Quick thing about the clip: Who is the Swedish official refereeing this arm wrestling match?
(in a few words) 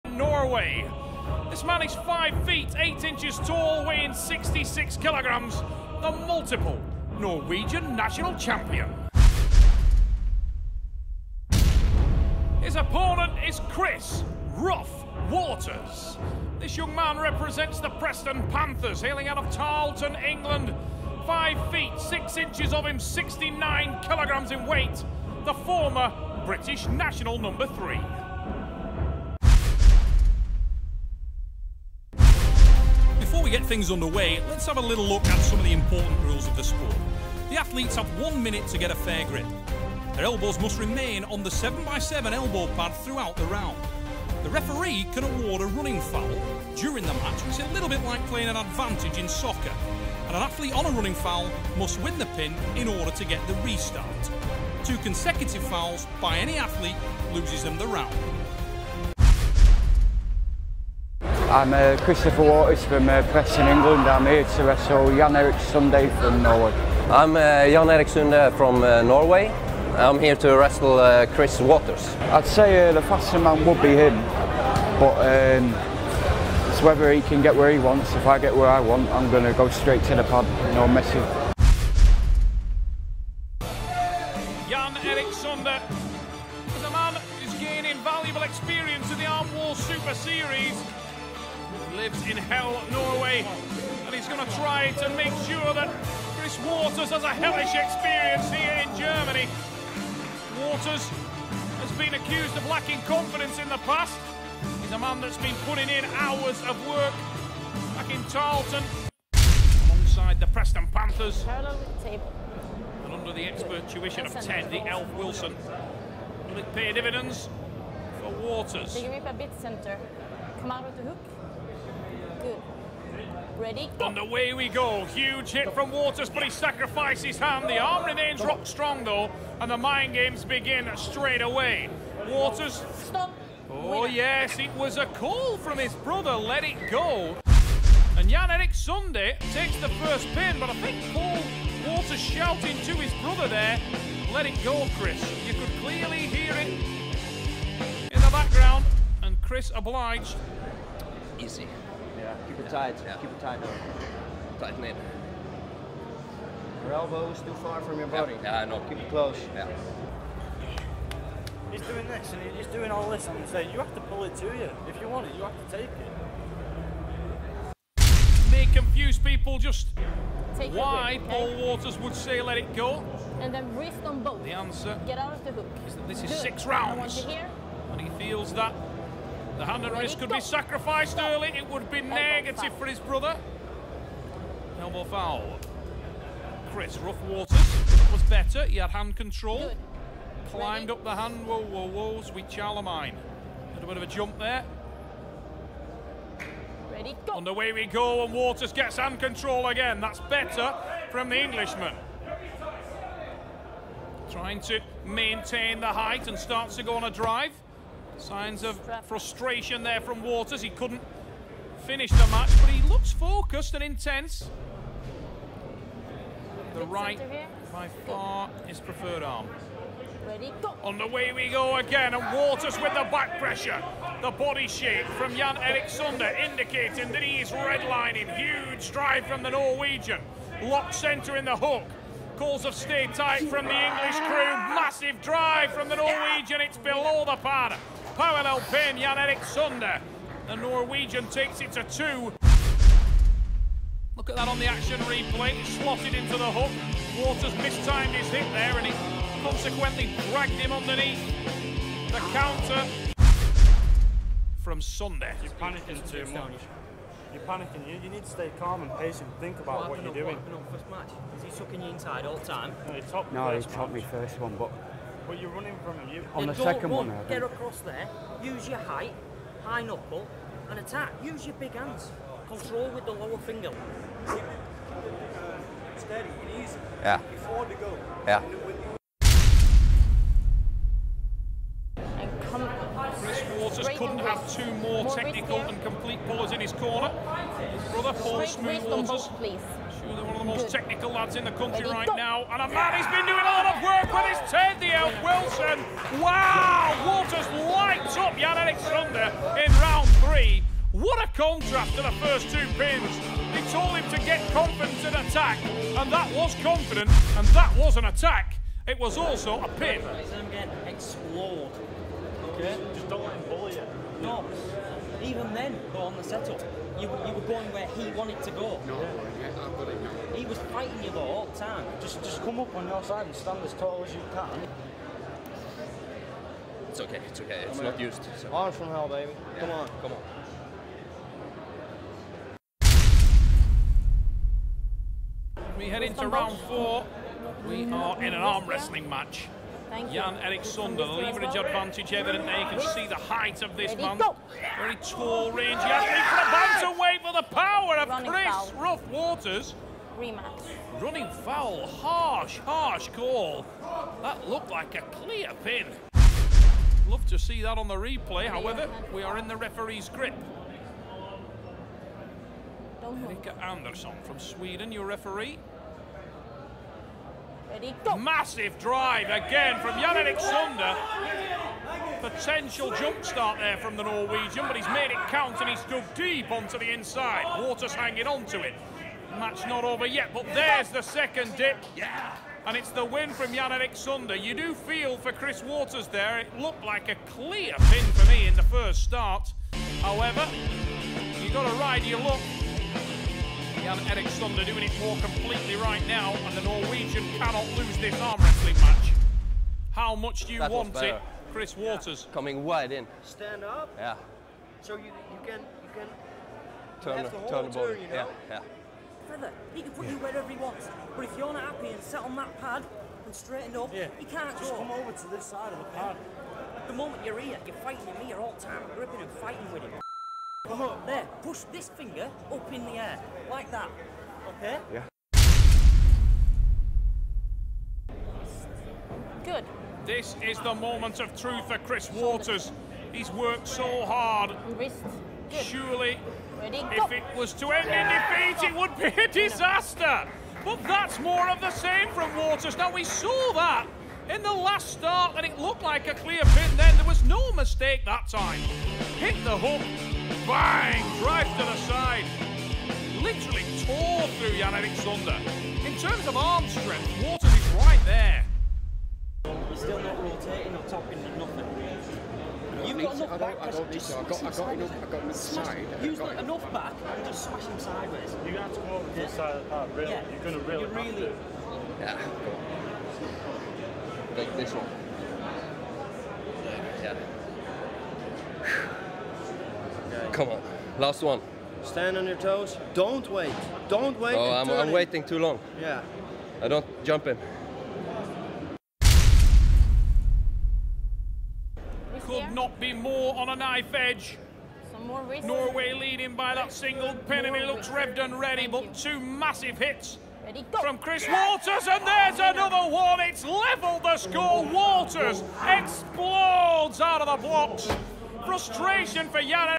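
Erika Andersson.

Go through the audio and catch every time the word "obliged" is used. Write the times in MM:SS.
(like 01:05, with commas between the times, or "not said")
02:29.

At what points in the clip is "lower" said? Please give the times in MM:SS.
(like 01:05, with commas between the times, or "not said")
04:33.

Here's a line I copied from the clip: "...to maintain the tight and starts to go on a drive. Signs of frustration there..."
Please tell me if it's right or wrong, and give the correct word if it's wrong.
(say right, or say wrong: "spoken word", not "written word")
wrong: "height", not "tight".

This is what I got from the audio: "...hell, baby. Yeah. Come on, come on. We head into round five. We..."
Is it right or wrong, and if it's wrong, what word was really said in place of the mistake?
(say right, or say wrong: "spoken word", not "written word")
wrong: "four", not "five".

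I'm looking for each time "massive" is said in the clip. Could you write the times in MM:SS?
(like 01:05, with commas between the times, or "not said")
03:54, 06:08, 08:19.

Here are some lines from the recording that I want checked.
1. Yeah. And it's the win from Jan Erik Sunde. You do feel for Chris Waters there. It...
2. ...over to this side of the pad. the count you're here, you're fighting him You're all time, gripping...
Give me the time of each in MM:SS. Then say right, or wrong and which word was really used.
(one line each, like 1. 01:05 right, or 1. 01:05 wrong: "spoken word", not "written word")
1. 06:21 right
2. 06:54 wrong: "moment", not "count".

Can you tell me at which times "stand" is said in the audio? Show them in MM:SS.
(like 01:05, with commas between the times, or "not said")
05:23, 06:43, 08:01.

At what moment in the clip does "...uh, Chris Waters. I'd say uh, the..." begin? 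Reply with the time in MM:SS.
01:10.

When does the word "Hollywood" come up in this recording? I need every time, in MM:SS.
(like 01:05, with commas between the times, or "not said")
not said.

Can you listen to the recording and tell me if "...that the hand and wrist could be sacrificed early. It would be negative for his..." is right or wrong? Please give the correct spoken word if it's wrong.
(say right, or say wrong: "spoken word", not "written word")
right.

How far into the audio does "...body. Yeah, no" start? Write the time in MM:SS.
02:38.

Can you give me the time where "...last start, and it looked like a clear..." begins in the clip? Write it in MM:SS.
07:24.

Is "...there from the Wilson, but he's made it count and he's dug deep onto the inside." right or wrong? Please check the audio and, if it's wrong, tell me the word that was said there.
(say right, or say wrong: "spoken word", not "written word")
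wrong: "Norwegian", not "Wilson".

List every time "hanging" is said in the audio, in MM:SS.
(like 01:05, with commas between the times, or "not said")
06:17.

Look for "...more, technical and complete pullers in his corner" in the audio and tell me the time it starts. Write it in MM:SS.
04:44.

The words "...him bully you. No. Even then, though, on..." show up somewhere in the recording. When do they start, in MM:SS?
05:13.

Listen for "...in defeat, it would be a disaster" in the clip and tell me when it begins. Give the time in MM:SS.
07:17.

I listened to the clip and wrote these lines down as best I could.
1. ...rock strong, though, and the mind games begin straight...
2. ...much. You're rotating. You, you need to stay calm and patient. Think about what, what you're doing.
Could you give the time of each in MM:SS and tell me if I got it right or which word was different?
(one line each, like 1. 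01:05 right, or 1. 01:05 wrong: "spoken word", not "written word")
1. 02:08 right
2. 04:16 wrong: "panicking", not "rotating".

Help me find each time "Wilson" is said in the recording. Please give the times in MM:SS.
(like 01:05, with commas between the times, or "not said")
01:55, 04:55.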